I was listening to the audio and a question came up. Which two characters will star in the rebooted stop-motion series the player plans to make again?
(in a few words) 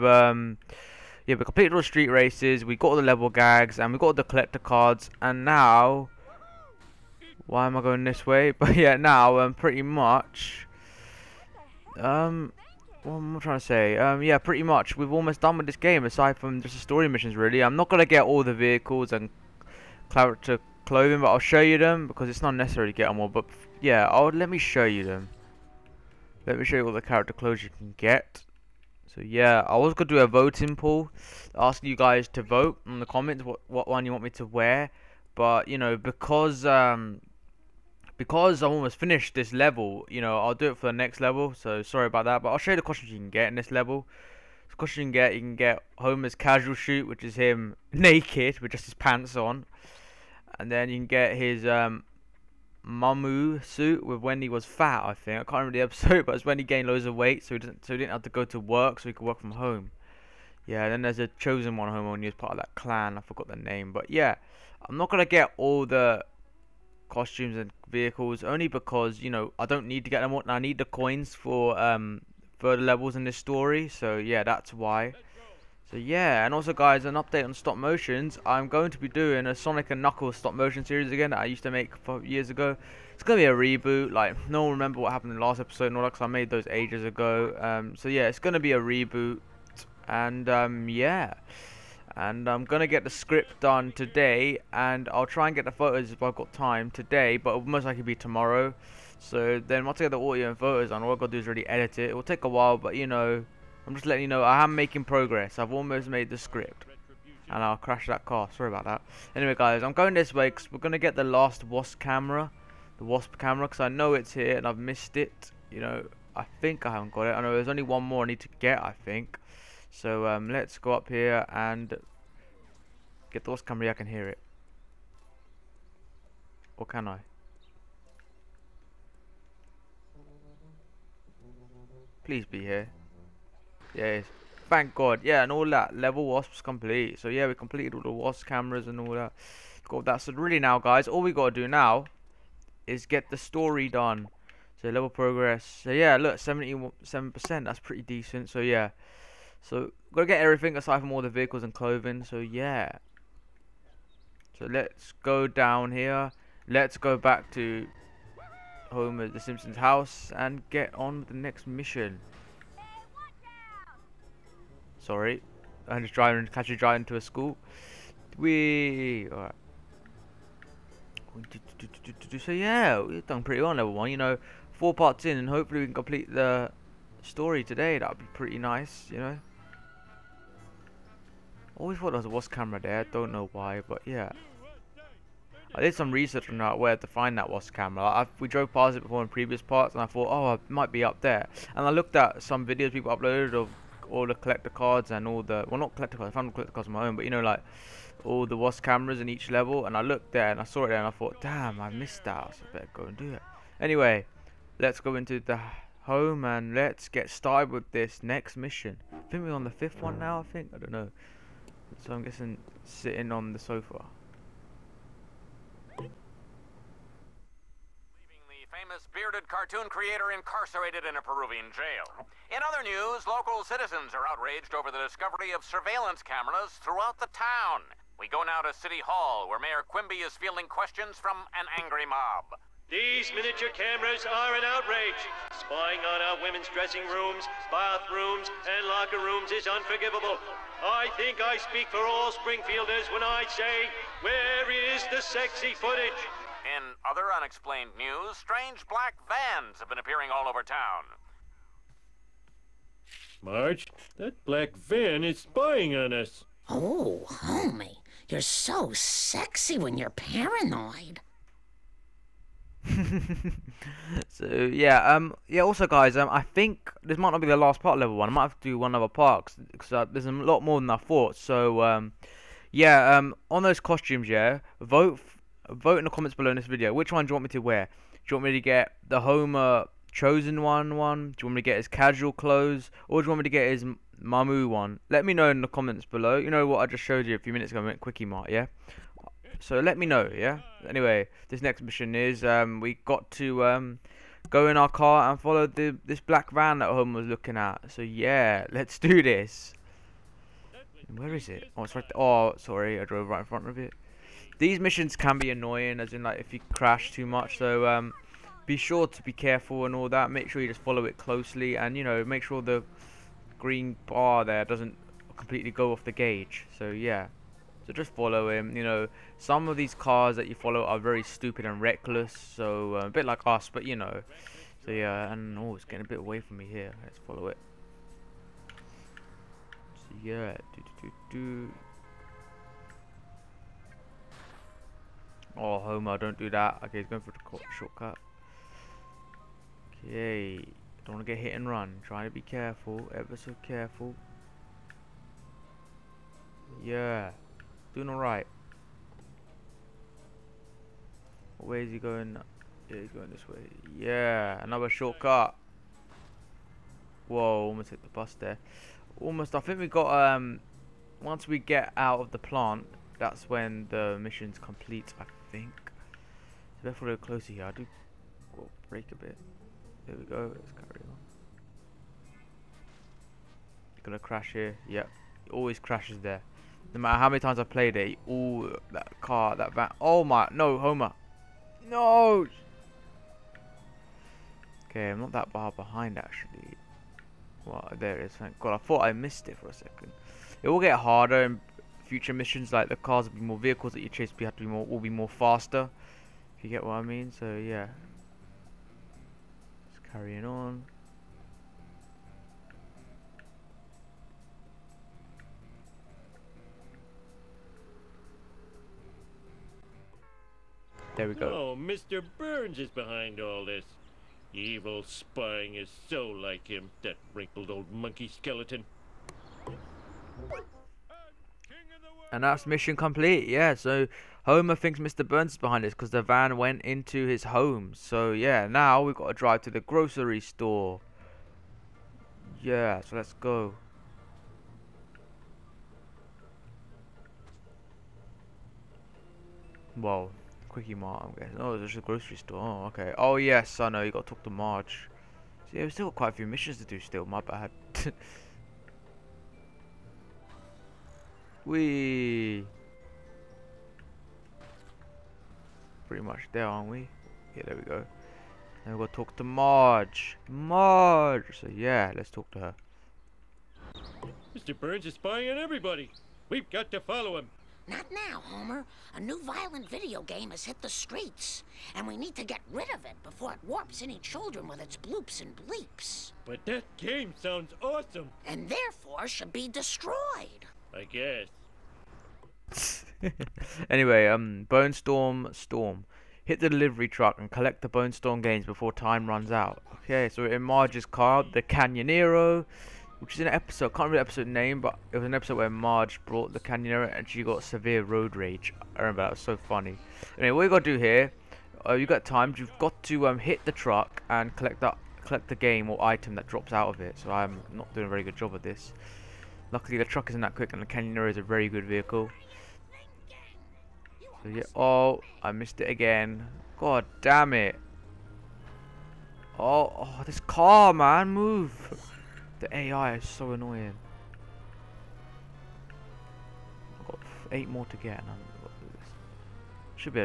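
Sonic and Knuckles.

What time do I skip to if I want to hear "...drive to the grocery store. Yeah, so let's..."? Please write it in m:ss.
7:09.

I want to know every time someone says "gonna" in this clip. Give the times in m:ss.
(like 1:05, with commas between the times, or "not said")
1:05, 1:23, 1:28, 1:32, 6:14.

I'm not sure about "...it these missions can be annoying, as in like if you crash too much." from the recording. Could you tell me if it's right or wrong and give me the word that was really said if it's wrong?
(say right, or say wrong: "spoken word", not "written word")
right.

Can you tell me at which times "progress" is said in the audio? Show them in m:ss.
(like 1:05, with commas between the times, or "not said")
1:45, 2:25.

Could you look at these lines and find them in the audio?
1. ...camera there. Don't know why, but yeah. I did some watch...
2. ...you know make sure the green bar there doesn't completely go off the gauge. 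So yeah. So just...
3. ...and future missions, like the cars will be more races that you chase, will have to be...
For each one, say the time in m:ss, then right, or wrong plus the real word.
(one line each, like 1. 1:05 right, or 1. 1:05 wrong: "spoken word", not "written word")
1. 3:02 wrong: "research", not "watch"
2. 5:11 right
3. 6:31 wrong: "vehicles", not "races".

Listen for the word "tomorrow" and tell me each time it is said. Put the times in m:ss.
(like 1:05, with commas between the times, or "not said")
1:38.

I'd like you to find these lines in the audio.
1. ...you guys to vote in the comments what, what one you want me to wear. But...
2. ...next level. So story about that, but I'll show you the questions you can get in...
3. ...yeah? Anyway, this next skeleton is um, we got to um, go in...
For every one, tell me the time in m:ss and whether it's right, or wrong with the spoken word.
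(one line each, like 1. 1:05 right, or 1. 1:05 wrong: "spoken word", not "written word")
1. 0:31 right
2. 0:40 wrong: "sorry", not "story"
3. 4:50 wrong: "mission", not "skeleton".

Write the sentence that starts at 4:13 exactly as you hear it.
Marge, that black van is spying on us.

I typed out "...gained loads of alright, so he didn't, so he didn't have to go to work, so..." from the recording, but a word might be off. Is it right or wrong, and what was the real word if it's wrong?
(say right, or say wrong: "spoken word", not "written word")
wrong: "weight", not "alright".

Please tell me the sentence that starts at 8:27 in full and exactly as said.
So I'm not doing a very good job of this.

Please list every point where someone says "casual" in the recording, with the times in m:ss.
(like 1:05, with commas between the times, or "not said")
0:46, 4:41.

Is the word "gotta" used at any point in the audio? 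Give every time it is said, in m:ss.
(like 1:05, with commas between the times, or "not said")
2:21, 2:30, 8:20.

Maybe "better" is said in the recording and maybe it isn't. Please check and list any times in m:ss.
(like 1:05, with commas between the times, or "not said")
3:22, 6:06.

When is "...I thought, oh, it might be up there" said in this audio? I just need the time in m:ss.
3:10.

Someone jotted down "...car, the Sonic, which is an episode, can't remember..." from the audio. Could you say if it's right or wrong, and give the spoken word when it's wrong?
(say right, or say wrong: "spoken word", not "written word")
wrong: "Canyonero", not "Sonic".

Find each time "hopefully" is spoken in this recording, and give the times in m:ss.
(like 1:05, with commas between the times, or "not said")
2:55.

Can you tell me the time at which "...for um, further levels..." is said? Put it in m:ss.
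1:11.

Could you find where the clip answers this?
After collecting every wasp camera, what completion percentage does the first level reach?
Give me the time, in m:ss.
2:26.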